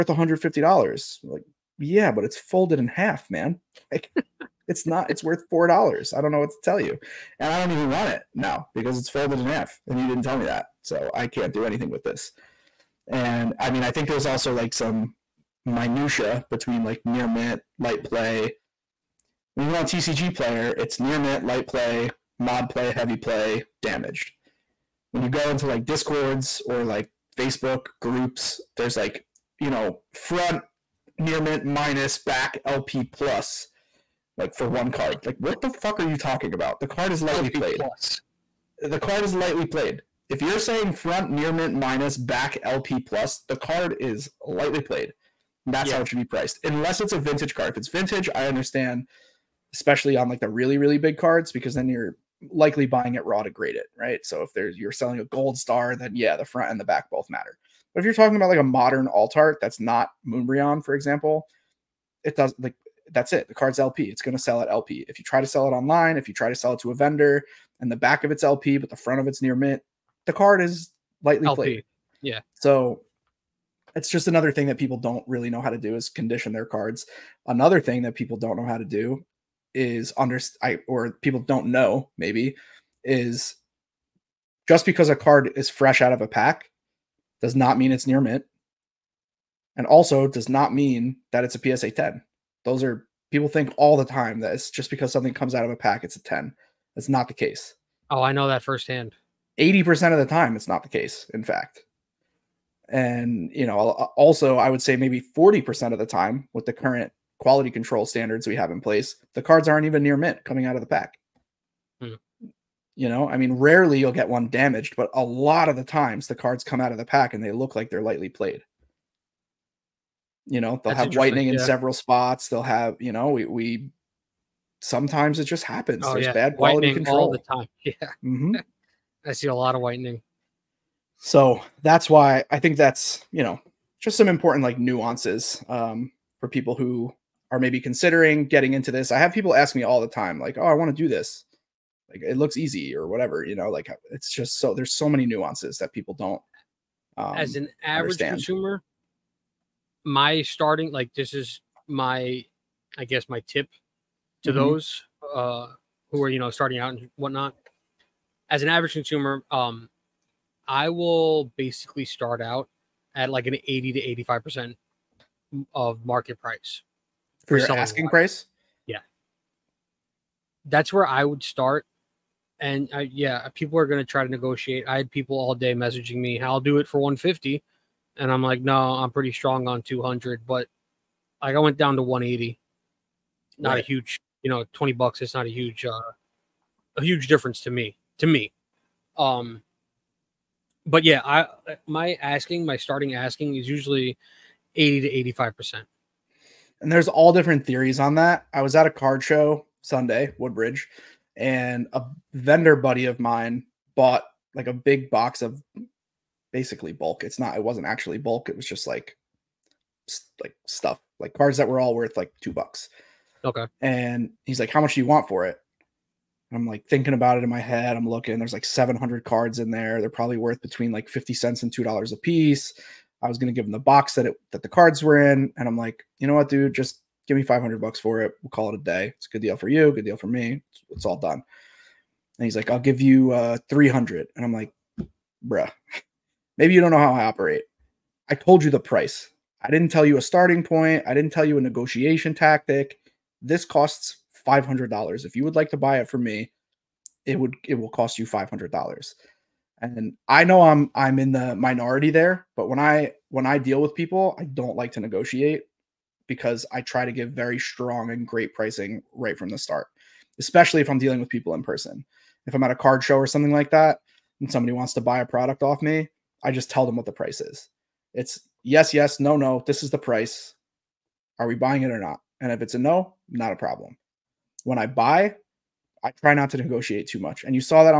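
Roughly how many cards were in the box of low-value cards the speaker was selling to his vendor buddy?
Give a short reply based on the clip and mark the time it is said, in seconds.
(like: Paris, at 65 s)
700, at 218 s.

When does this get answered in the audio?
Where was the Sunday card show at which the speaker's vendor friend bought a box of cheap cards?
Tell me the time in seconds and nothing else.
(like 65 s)
200 s.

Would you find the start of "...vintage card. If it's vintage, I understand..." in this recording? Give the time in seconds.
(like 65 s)
47 s.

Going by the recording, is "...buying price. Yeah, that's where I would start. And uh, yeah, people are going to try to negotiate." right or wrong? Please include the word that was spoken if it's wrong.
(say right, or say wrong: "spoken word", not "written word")
wrong: "asking", not "buying".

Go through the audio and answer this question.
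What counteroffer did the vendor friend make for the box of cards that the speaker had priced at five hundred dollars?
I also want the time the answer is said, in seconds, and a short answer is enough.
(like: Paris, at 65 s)
$300, at 233 s.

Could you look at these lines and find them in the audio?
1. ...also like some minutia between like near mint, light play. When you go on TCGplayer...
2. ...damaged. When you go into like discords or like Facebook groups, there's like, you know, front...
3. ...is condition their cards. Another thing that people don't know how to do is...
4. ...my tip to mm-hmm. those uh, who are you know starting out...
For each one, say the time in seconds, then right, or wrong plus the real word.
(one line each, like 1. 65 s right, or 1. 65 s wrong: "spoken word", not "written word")
1. 14 s right
2. 23 s right
3. 75 s right
4. 153 s right.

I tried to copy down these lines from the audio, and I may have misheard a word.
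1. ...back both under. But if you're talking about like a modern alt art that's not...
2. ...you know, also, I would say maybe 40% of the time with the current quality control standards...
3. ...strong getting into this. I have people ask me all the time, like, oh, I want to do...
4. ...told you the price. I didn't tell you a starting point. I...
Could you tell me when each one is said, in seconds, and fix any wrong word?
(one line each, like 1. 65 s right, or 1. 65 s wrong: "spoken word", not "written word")
1. 56 s wrong: "matter", not "under"
2. 103 s right
3. 137 s wrong: "considering", not "strong"
4. 238 s right.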